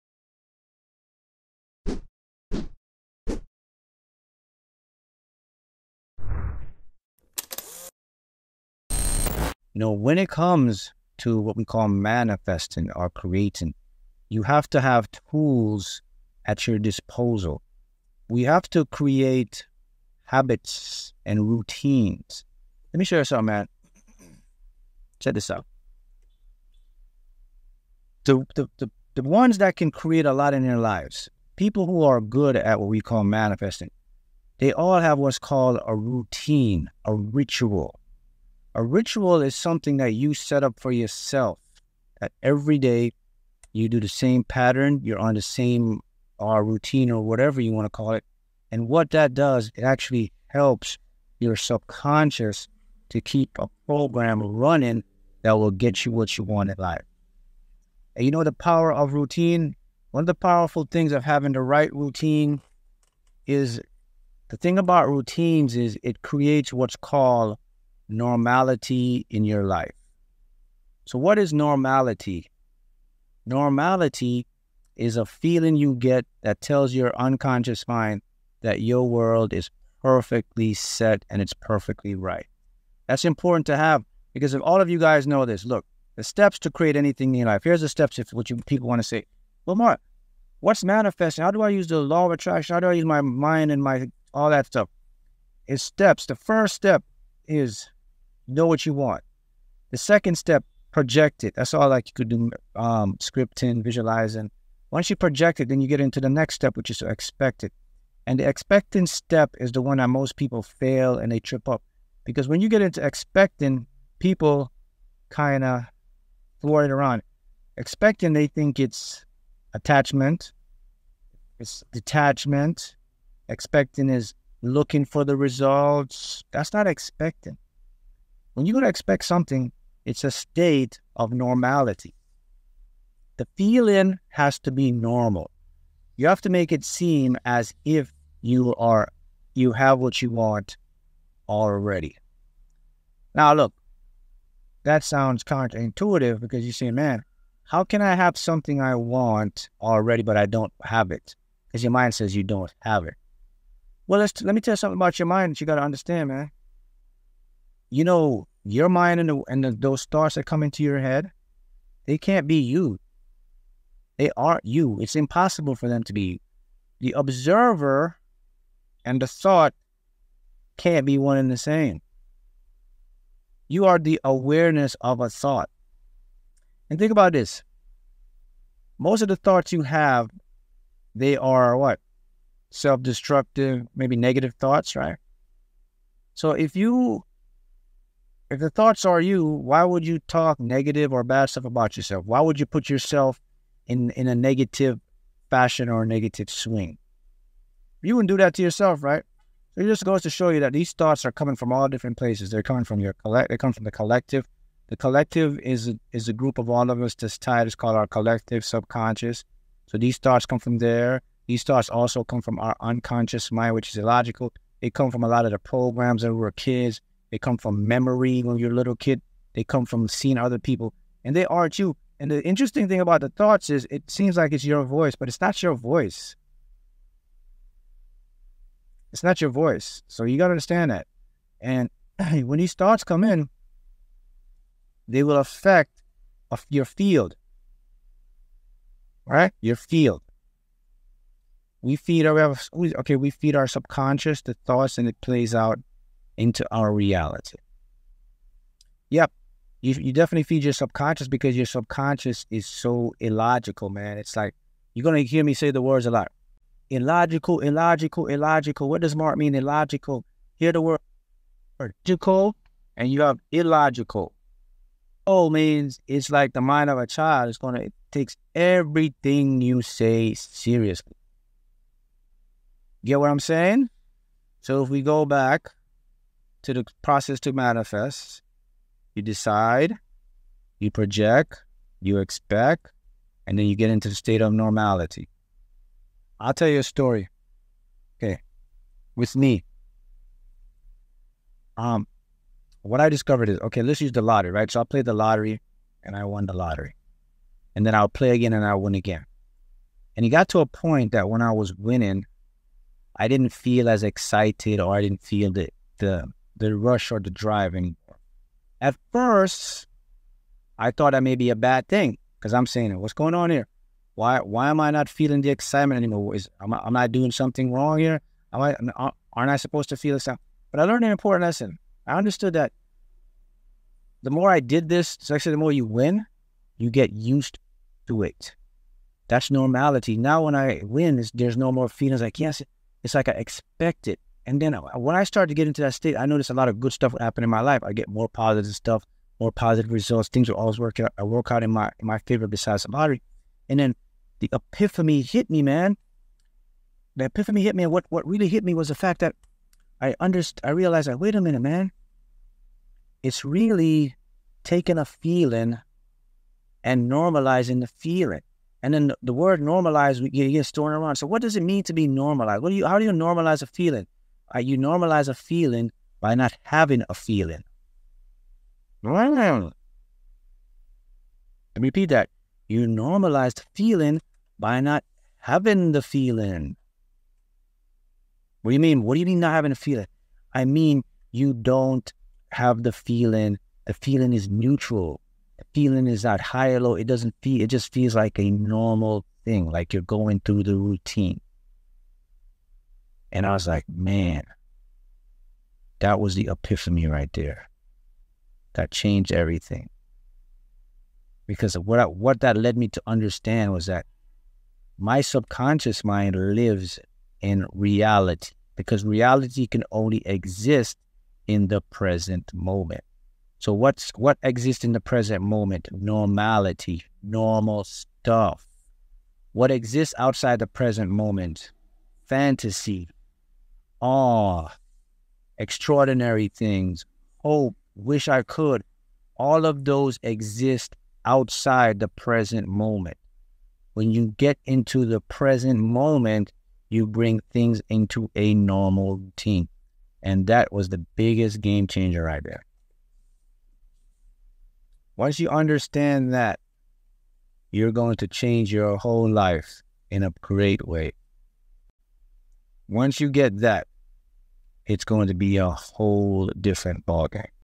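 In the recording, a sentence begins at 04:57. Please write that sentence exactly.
And then I'll play again and I'll win again.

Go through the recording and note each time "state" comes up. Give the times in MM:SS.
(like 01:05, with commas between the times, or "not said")
02:10, 04:44, 05:35.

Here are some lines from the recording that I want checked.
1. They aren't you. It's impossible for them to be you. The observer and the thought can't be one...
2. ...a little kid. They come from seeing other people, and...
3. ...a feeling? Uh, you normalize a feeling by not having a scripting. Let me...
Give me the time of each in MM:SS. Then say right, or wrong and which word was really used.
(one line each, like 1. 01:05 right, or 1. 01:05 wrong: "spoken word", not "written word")
1. 02:44 right
2. 03:38 right
3. 06:03 wrong: "feeling", not "scripting".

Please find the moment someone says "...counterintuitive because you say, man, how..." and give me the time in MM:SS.
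02:25.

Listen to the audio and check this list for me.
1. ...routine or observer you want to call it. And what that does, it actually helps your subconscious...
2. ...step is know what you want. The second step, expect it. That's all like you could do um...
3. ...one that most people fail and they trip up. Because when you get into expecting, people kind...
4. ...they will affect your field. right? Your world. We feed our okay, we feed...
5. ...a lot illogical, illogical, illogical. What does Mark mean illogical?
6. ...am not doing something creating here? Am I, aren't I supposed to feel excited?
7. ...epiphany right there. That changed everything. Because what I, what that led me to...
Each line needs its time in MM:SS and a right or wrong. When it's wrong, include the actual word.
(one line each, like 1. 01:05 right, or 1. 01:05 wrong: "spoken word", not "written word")
1. 00:46 wrong: "whatever", not "observer"
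2. 01:36 wrong: "project", not "expect"
3. 01:49 right
4. 03:55 wrong: "field", not "world"
5. 04:16 right
6. 05:16 wrong: "wrong", not "creating"
7. 06:36 right.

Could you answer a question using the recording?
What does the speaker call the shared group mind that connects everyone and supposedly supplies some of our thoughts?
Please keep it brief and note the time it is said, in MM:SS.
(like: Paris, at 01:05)
collective subconscious, at 03:28.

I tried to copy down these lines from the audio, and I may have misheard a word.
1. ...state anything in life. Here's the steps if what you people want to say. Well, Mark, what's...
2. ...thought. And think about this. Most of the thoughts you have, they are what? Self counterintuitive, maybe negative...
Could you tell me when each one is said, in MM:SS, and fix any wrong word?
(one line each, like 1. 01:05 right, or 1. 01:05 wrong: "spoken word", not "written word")
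1. 01:26 wrong: "create", not "state"
2. 02:55 wrong: "destructive", not "counterintuitive".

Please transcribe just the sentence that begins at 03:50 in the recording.
So you got to understand that.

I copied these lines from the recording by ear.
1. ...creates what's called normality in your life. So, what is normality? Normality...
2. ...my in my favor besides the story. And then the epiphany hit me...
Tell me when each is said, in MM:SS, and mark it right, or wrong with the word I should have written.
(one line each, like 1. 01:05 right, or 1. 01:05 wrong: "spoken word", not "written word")
1. 01:06 right
2. 05:41 wrong: "lottery", not "story".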